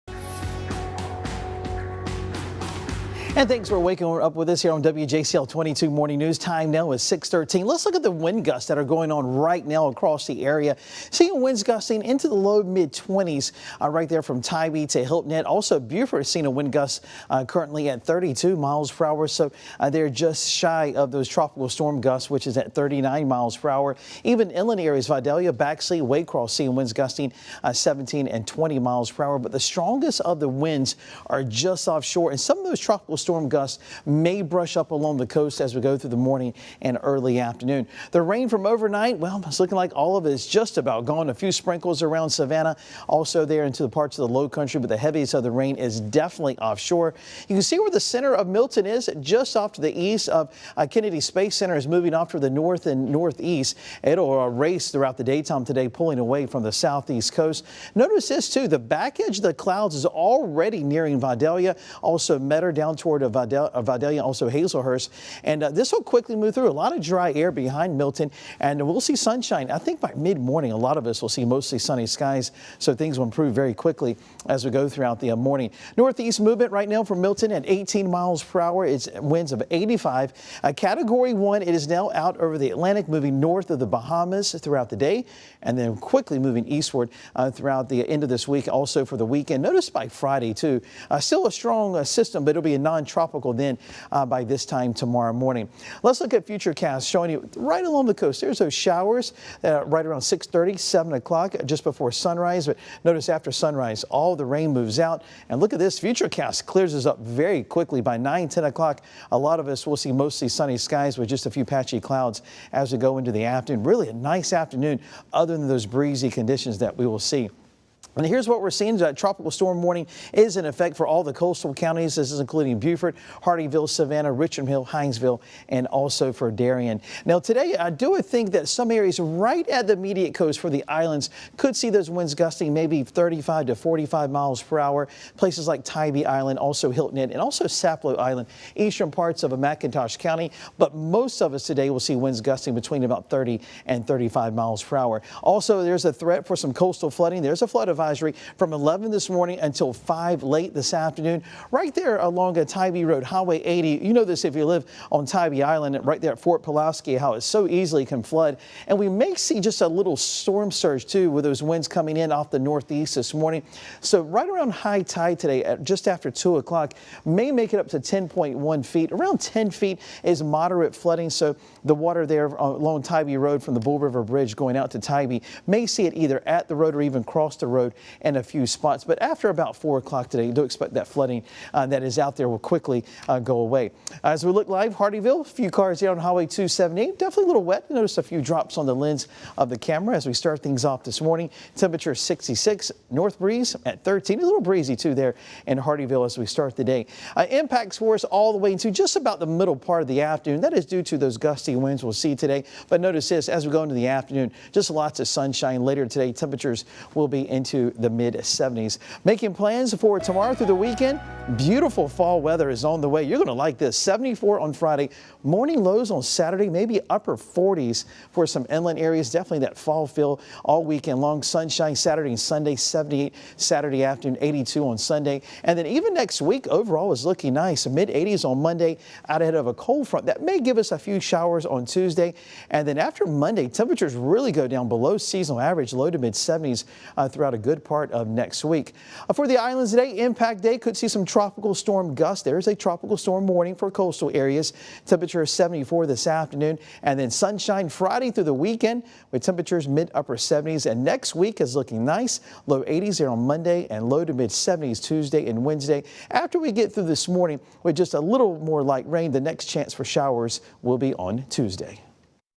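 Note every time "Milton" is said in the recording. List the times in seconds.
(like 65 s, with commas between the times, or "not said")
48 s, 67 s, 77 s.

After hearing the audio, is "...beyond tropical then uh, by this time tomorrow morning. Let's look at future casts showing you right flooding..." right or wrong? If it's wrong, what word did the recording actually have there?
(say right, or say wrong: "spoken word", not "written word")
wrong: "along", not "flooding".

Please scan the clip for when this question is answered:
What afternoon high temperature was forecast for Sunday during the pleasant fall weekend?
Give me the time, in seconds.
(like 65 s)
224 s.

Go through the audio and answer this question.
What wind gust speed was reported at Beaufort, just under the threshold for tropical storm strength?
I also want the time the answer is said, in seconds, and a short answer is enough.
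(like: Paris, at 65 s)
32 mph, at 18 s.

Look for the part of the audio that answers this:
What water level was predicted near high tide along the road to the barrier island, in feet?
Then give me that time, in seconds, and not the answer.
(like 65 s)
167 s.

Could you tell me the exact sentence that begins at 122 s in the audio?
This is including Beaufort, Hardeeville, Savannah, Richmond Hill, Hinesville, and also for Darien.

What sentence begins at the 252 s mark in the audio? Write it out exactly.
Low 80s there on Monday and low to mid 70s Tuesday and Wednesday.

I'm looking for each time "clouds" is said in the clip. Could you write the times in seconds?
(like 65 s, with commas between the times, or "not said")
59 s, 111 s.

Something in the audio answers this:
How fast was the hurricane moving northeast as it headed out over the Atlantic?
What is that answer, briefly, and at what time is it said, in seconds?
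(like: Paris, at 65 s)
18 mph, at 77 s.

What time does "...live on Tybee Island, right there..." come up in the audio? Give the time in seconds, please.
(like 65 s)
154 s.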